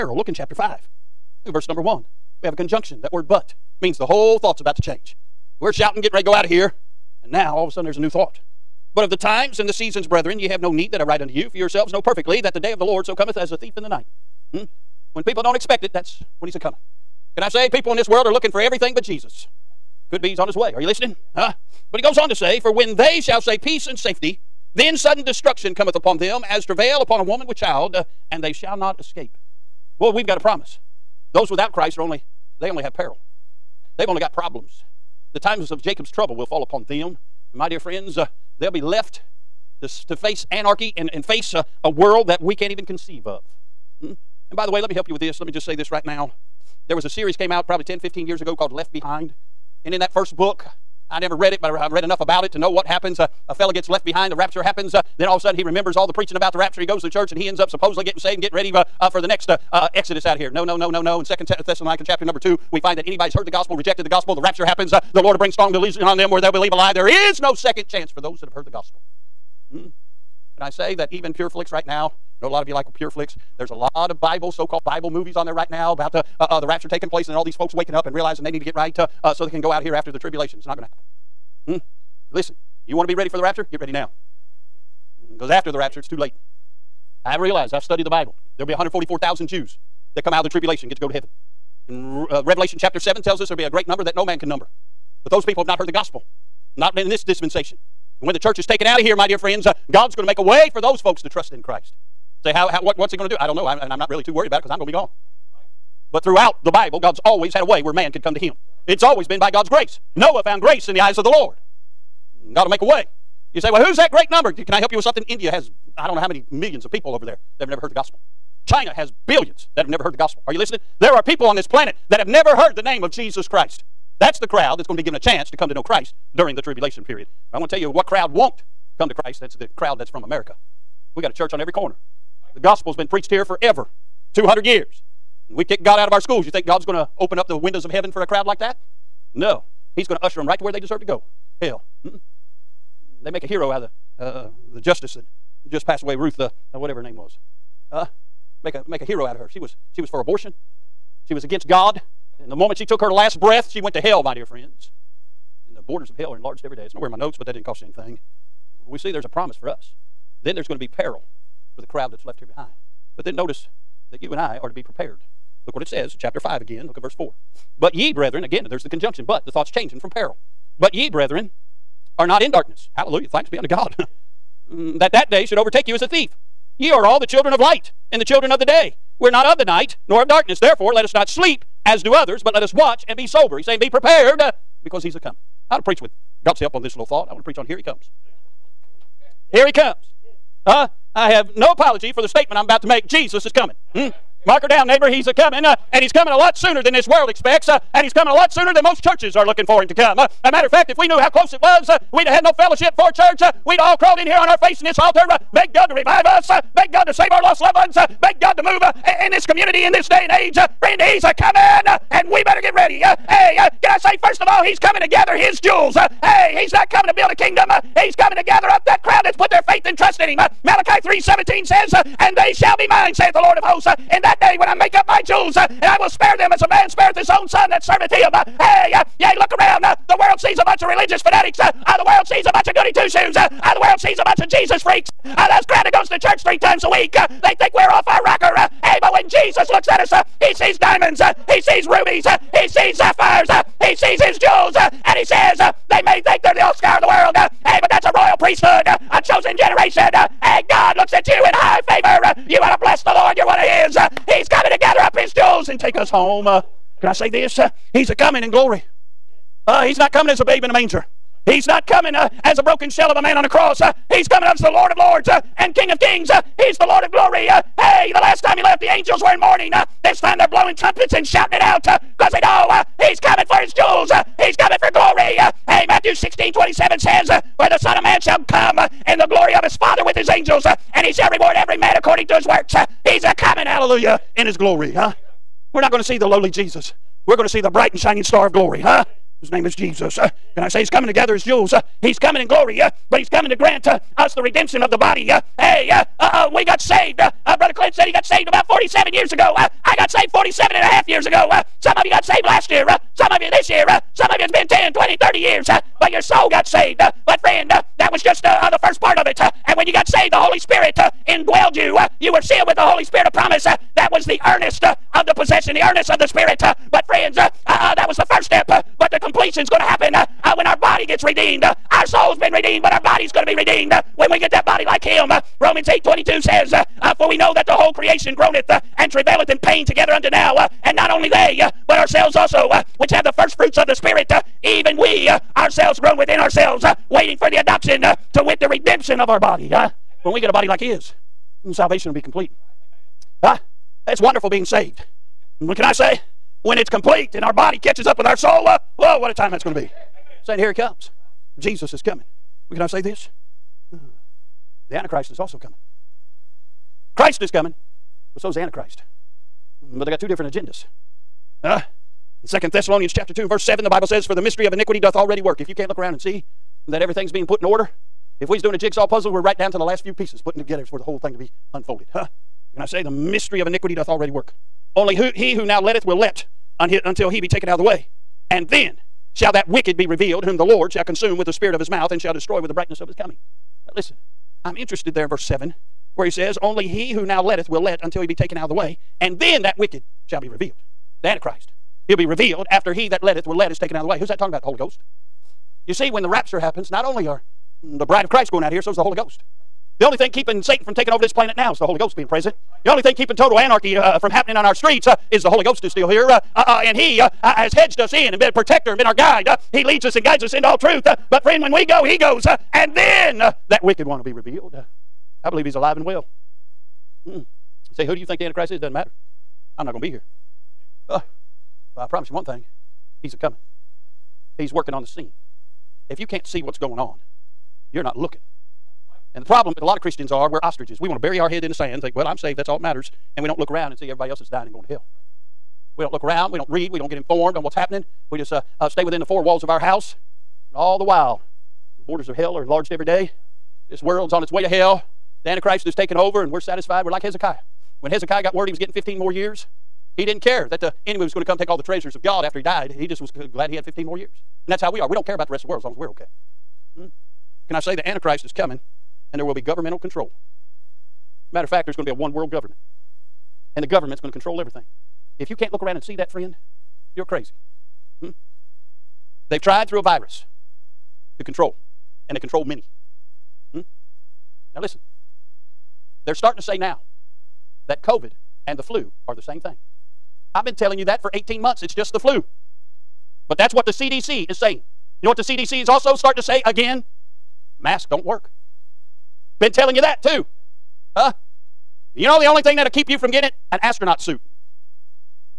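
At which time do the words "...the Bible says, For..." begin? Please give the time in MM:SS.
06:03.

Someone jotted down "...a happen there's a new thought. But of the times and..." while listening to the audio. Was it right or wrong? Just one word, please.
wrong.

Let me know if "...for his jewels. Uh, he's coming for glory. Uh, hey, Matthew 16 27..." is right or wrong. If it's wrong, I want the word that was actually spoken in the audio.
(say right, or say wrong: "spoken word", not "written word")
right.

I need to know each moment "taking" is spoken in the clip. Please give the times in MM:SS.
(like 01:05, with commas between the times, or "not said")
01:16, 06:40, 07:25.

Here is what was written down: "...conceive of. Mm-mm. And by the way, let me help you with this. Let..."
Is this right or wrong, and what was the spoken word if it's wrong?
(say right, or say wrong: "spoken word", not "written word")
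right.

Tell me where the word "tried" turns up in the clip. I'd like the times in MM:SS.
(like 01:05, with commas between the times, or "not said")
07:49.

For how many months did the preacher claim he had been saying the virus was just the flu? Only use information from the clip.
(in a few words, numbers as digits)
18.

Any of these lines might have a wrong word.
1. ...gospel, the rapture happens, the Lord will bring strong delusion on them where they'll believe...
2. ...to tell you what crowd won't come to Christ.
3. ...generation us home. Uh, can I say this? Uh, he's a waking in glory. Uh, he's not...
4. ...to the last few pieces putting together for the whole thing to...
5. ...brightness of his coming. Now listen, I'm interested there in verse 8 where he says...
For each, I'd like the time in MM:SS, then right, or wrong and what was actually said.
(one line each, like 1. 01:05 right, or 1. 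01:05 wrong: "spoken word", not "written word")
1. 01:04 right
2. 02:07 right
3. 04:09 wrong: "coming", not "waking"
4. 06:09 right
5. 06:22 wrong: "7", not "8".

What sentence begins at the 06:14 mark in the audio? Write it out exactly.
Only who, he who now letteth will let until he be taken out of the way.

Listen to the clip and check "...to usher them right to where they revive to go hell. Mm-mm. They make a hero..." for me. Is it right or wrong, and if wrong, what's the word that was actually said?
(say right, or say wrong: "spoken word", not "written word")
wrong: "deserve", not "revive".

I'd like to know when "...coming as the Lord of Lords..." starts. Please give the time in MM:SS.
04:24.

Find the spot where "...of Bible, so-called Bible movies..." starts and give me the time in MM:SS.
01:14.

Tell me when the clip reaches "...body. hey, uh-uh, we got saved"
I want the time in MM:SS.
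04:54.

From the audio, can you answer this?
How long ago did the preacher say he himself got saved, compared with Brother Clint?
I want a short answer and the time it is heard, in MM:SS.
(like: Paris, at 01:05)
47 and a half years, at 05:00.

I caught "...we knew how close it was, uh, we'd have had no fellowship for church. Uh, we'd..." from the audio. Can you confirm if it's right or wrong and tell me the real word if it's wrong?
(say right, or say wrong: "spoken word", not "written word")
right.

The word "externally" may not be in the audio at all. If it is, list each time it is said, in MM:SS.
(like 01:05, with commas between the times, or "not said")
not said.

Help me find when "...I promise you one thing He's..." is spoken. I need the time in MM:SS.
07:01.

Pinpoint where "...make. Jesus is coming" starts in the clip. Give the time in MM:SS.
03:12.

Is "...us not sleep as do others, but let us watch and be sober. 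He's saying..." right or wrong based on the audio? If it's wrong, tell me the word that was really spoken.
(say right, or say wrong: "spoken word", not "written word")
right.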